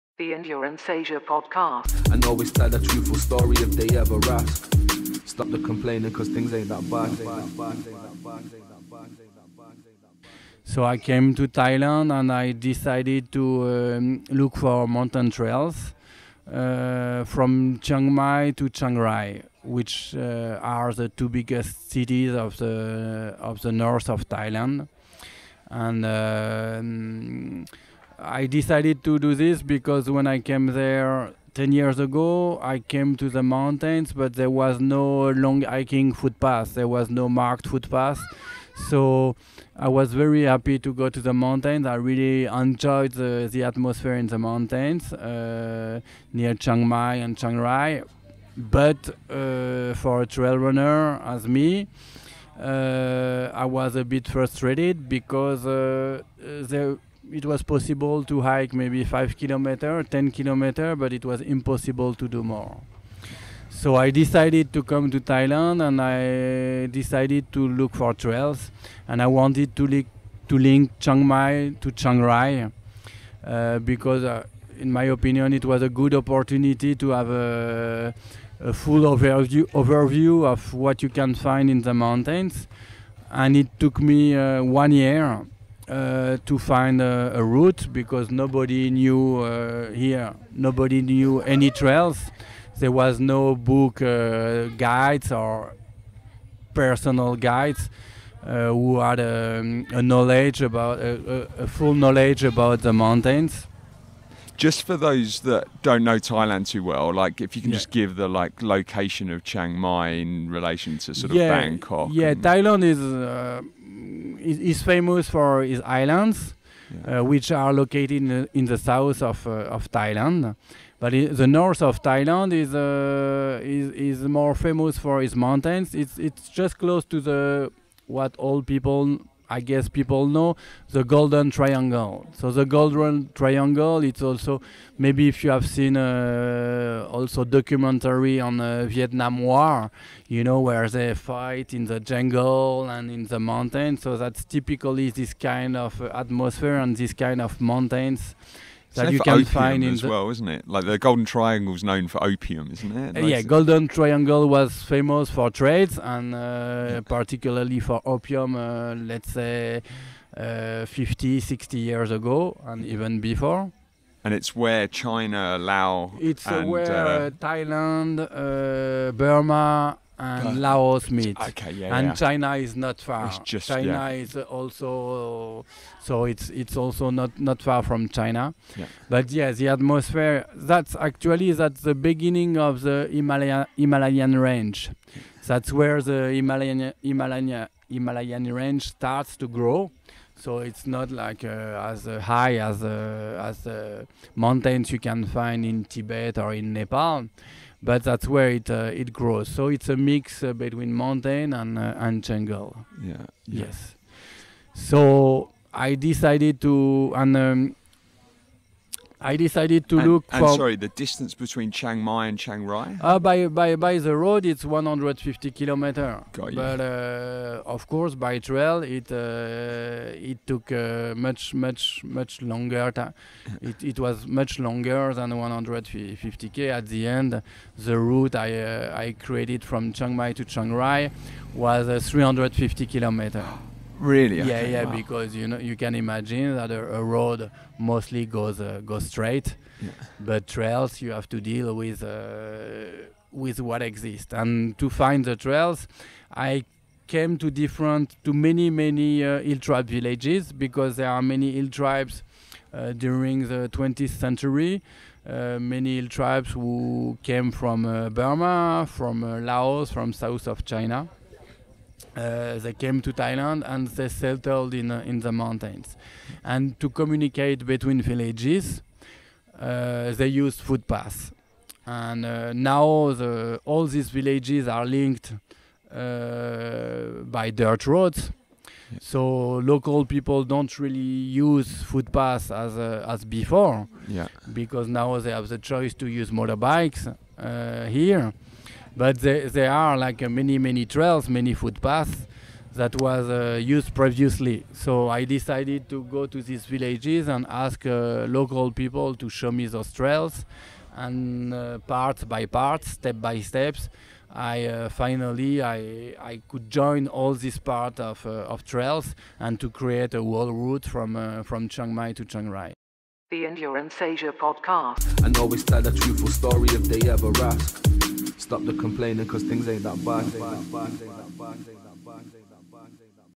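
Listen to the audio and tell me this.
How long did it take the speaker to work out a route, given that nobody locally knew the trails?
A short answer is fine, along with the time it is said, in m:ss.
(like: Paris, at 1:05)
1 year, at 1:24.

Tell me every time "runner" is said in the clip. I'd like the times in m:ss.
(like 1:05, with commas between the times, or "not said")
0:50.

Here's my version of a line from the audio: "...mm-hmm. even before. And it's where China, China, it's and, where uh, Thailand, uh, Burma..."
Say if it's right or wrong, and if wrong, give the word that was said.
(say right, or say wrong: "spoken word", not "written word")
wrong: "Laos", not "China".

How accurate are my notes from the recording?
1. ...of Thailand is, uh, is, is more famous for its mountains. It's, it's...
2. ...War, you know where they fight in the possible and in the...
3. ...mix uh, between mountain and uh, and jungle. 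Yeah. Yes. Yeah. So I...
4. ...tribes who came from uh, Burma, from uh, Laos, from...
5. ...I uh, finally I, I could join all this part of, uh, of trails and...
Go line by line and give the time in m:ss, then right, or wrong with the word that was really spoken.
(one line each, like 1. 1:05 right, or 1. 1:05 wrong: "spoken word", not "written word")
1. 2:01 right
2. 2:19 wrong: "jungle", not "possible"
3. 3:19 right
4. 4:16 right
5. 5:04 right.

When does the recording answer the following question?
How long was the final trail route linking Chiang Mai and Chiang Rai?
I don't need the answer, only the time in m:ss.
3:52.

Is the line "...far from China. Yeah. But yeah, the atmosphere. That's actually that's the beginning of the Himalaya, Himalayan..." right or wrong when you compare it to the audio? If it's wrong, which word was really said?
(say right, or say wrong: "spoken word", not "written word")
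right.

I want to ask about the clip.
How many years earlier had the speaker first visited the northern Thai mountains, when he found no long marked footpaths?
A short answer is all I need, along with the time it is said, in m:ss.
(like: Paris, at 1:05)
10 years, at 0:31.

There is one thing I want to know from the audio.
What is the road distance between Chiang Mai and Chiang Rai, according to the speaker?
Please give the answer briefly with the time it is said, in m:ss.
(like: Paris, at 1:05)
150 km, at 3:34.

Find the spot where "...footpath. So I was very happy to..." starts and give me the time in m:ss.
0:37.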